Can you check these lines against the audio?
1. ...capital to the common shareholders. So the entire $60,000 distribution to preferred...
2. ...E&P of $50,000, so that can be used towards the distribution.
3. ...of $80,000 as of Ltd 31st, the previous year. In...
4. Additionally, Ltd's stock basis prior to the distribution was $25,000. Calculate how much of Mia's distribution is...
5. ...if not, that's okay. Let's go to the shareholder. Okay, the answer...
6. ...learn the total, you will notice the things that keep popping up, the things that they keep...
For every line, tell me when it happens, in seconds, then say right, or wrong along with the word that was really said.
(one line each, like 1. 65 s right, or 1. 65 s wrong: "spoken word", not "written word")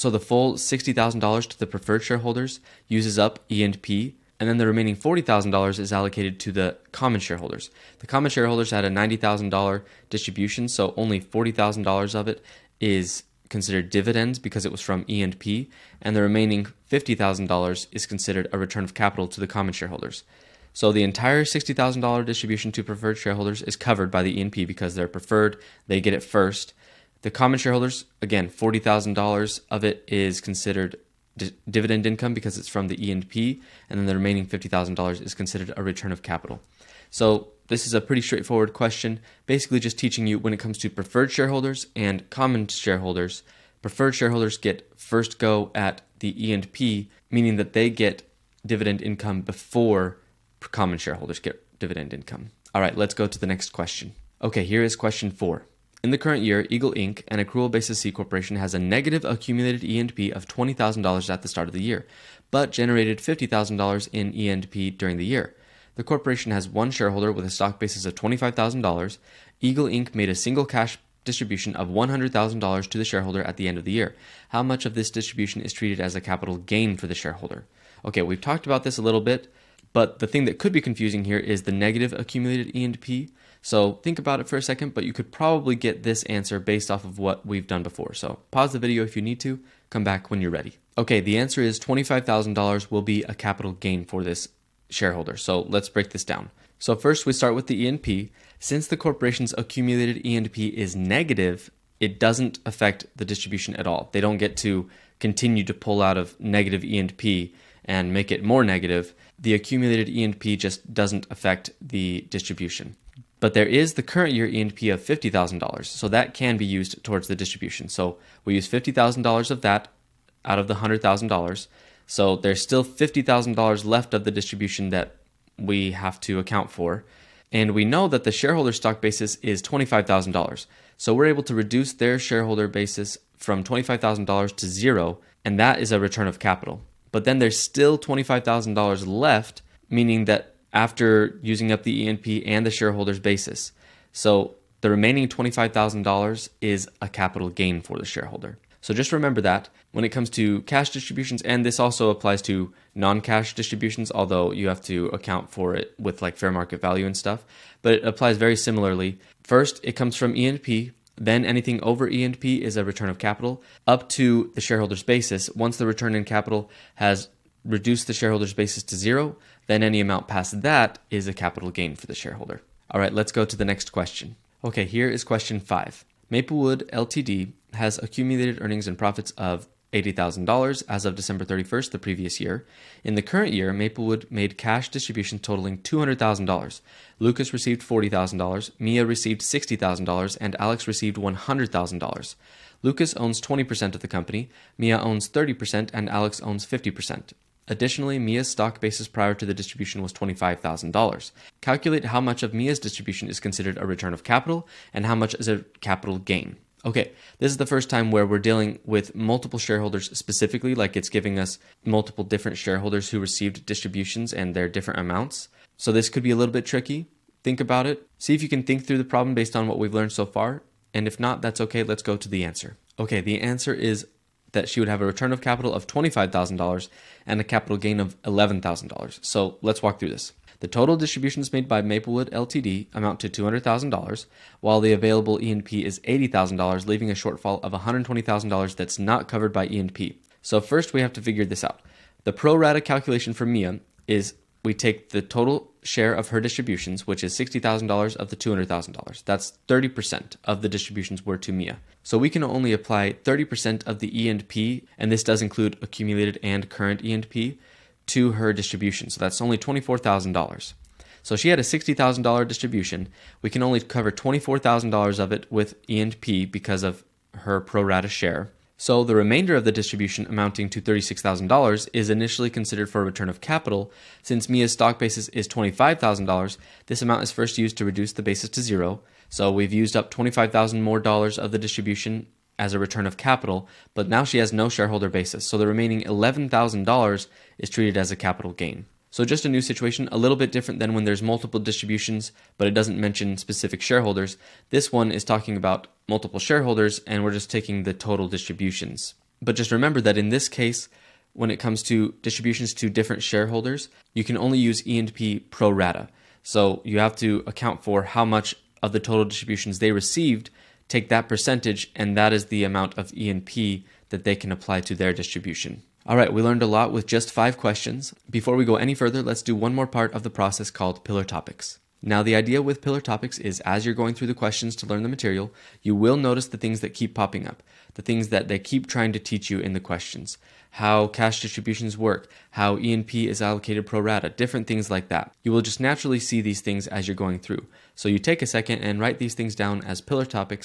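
1. 18 s right
2. 114 s right
3. 179 s wrong: "December", not "Ltd"
4. 197 s wrong: "Mia", not "Ltd"
5. 221 s wrong: "answer", not "shareholder"
6. 324 s wrong: "material", not "total".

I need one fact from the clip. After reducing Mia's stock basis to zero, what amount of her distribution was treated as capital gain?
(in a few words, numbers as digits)
$11,000.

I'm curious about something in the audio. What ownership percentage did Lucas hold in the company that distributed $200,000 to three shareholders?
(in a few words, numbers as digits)
20%.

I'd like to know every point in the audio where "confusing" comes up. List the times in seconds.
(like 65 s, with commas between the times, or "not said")
80 s.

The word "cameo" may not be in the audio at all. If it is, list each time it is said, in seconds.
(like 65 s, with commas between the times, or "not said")
not said.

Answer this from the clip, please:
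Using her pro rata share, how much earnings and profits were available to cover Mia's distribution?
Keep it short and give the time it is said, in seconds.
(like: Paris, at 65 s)
$24,000, at 259 s.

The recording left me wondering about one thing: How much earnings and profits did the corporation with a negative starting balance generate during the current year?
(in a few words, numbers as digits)
$50,000.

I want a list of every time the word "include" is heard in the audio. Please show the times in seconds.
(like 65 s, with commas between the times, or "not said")
255 s.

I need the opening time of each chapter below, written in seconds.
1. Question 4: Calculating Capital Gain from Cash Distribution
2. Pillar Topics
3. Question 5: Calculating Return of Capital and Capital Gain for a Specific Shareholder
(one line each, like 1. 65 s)
1. 53 s
2. 321 s
3. 173 s.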